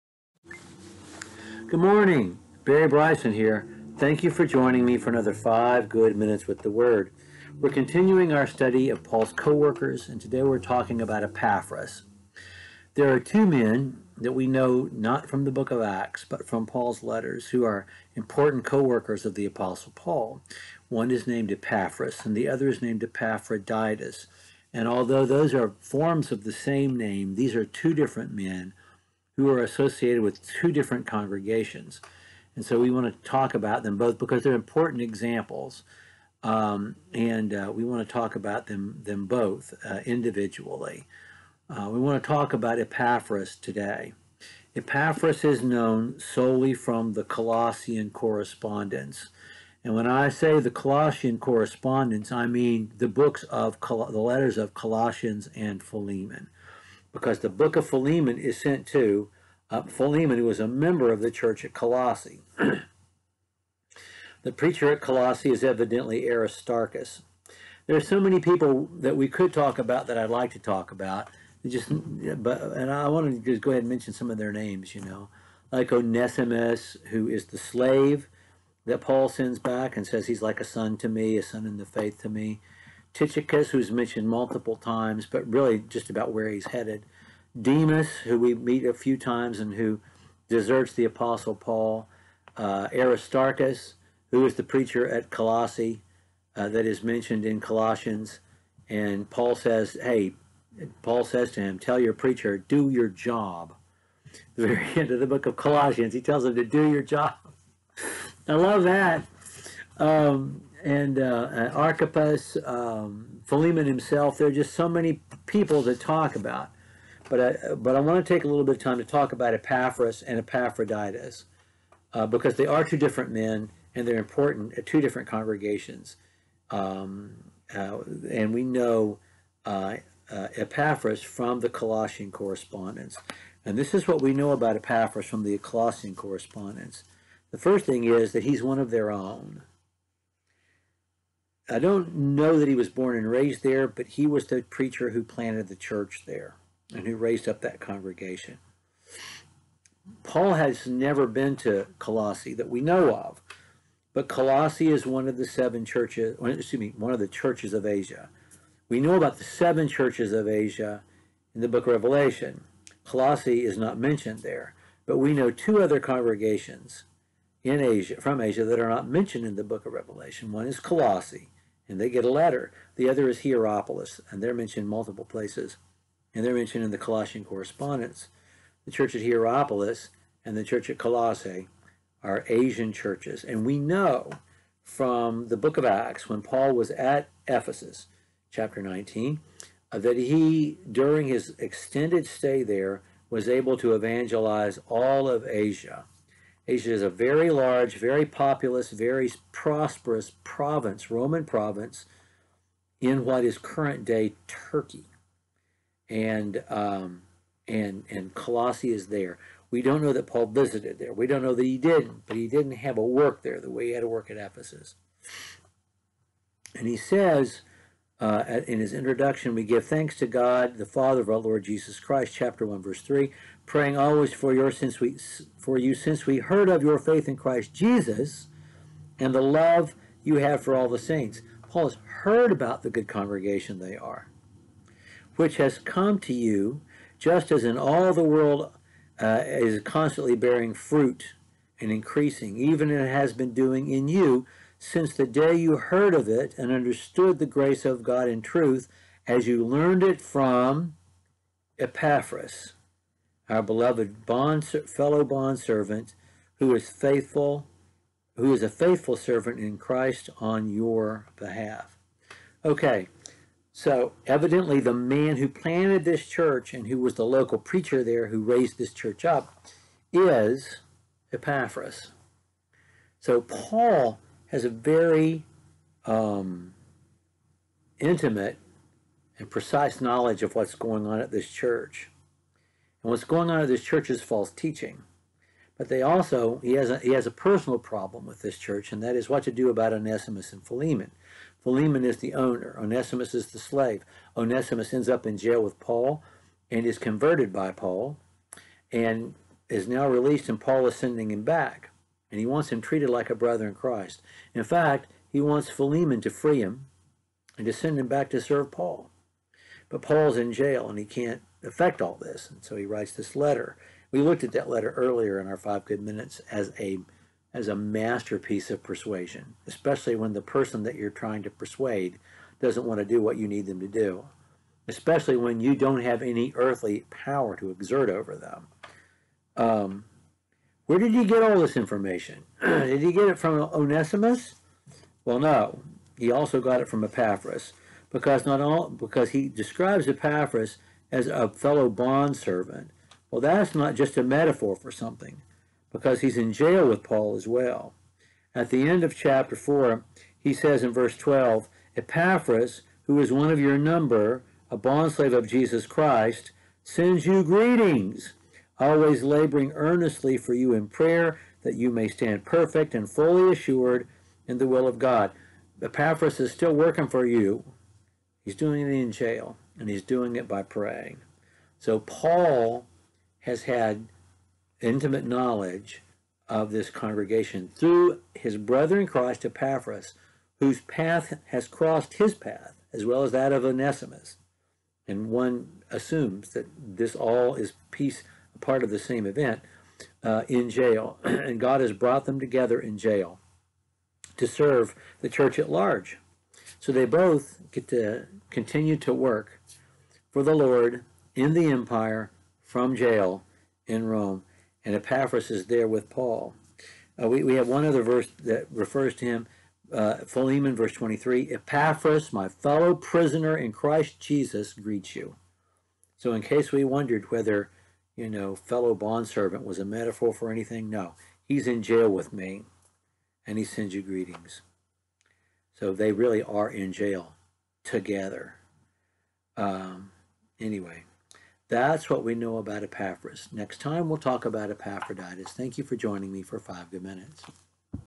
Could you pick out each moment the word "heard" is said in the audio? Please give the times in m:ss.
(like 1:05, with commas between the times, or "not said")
3:46, 3:52, 4:05.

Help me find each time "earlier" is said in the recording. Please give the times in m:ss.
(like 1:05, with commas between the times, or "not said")
5:14.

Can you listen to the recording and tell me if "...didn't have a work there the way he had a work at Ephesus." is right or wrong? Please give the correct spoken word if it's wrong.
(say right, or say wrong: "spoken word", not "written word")
right.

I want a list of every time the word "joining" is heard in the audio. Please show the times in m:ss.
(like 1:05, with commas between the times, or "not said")
0:04, 7:15.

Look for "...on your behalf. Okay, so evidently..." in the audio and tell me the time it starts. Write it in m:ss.
4:20.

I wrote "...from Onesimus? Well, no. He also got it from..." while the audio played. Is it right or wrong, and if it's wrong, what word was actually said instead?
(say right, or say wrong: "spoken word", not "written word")
right.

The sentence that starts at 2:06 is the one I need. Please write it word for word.
Um, uh, and we know uh, uh Epaphras from the Colossian correspondence.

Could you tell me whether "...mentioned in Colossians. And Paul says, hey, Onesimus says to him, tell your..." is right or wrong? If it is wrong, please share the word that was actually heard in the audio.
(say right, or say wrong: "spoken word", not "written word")
wrong: "Paul", not "Onesimus".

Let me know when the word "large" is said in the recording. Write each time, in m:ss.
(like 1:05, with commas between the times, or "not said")
3:17, 6:35.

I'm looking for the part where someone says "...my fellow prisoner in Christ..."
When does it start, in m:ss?
6:52.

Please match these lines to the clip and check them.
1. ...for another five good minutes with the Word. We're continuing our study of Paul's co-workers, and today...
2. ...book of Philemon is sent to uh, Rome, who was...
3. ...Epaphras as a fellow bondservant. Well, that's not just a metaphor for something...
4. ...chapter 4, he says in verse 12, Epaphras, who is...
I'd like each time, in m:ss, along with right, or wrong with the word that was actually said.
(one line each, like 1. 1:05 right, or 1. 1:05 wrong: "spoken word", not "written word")
1. 0:04 right
2. 0:57 wrong: "Philemon", not "Rome"
3. 5:40 right
4. 5:49 right.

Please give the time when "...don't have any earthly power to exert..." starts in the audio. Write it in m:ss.
5:25.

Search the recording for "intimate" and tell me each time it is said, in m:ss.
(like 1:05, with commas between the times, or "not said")
4:37, 6:14.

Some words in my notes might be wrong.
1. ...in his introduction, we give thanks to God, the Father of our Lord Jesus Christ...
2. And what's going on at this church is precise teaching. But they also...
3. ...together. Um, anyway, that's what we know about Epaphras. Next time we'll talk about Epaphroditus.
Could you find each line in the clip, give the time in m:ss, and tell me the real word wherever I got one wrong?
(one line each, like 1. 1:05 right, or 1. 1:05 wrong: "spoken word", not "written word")
1. 3:38 right
2. 4:43 wrong: "false", not "precise"
3. 7:07 right.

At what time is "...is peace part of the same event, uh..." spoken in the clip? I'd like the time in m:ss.
6:27.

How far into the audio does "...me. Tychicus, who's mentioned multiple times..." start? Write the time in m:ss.
1:22.